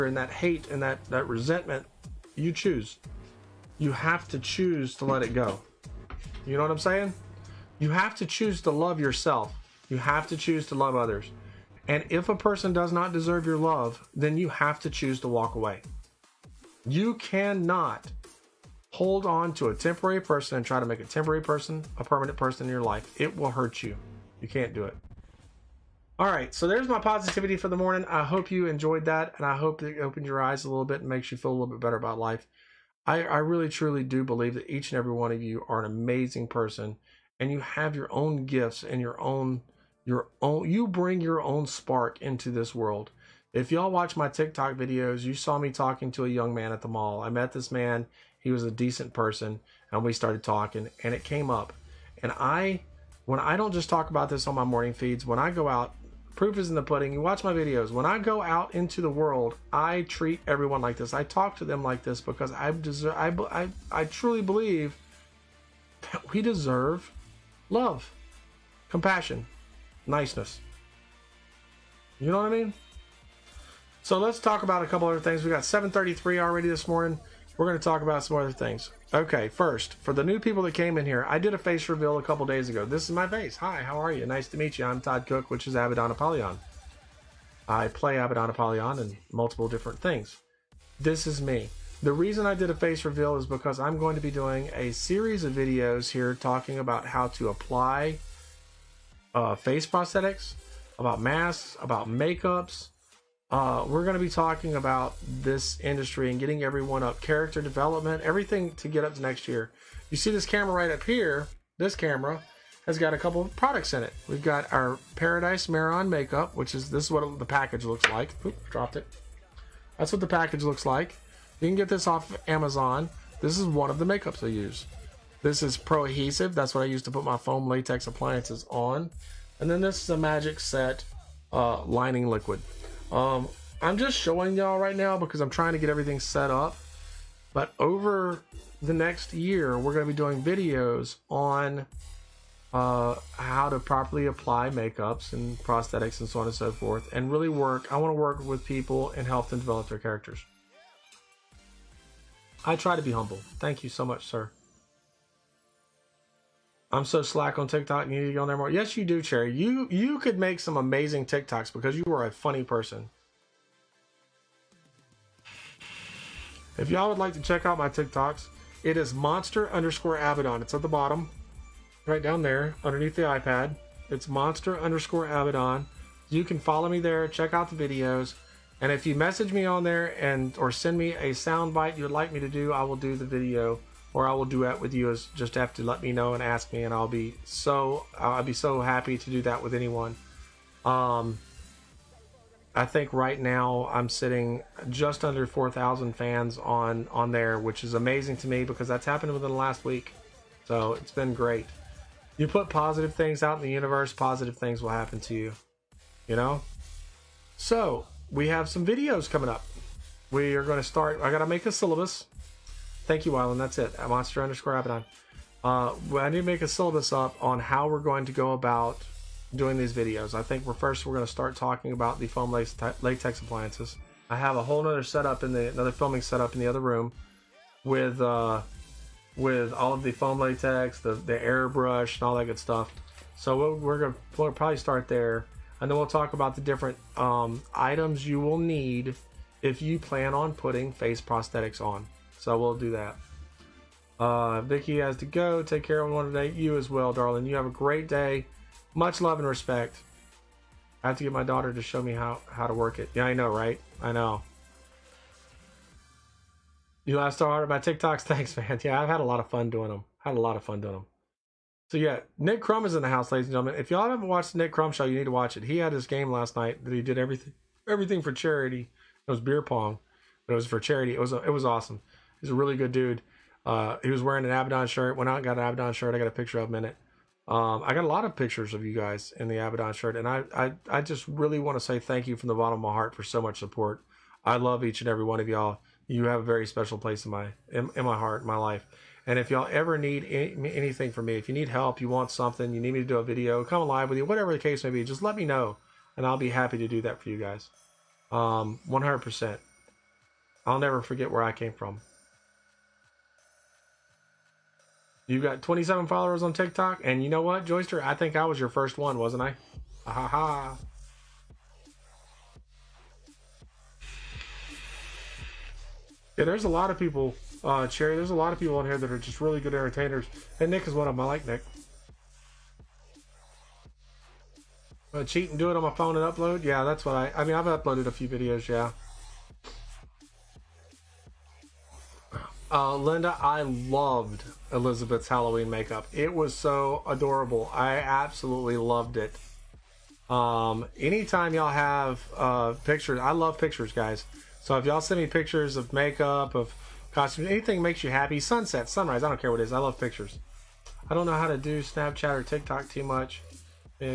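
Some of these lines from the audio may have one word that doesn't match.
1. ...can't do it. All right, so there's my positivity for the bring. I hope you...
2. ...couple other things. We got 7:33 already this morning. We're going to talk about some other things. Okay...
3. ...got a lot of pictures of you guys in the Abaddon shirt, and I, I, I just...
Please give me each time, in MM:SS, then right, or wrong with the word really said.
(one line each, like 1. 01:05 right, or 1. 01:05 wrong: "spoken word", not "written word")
1. 00:24 wrong: "morning", not "bring"
2. 01:14 right
3. 04:37 right.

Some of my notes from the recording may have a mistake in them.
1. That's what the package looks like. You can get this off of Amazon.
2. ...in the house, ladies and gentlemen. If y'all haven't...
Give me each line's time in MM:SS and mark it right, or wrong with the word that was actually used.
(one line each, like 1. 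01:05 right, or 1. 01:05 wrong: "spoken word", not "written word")
1. 01:59 right
2. 04:22 right.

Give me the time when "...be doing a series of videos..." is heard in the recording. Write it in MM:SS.
01:34.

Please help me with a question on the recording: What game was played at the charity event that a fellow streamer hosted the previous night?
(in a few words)
Beer pong.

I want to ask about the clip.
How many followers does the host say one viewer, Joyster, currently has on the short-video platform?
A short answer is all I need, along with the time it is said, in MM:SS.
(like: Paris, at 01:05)
27, at 05:05.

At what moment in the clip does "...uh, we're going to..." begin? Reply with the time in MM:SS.
01:43.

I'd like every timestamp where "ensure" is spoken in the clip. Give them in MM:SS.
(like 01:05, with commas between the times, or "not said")
not said.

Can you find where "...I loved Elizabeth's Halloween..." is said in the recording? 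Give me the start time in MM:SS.
05:33.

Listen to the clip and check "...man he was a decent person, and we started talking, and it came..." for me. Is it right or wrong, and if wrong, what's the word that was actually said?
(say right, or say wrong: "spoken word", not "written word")
right.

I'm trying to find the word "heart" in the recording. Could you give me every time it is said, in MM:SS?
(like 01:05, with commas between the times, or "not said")
04:42, 04:48.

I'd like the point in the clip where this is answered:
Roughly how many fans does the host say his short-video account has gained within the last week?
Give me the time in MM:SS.
03:14.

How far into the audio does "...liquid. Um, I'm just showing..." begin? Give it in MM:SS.
02:12.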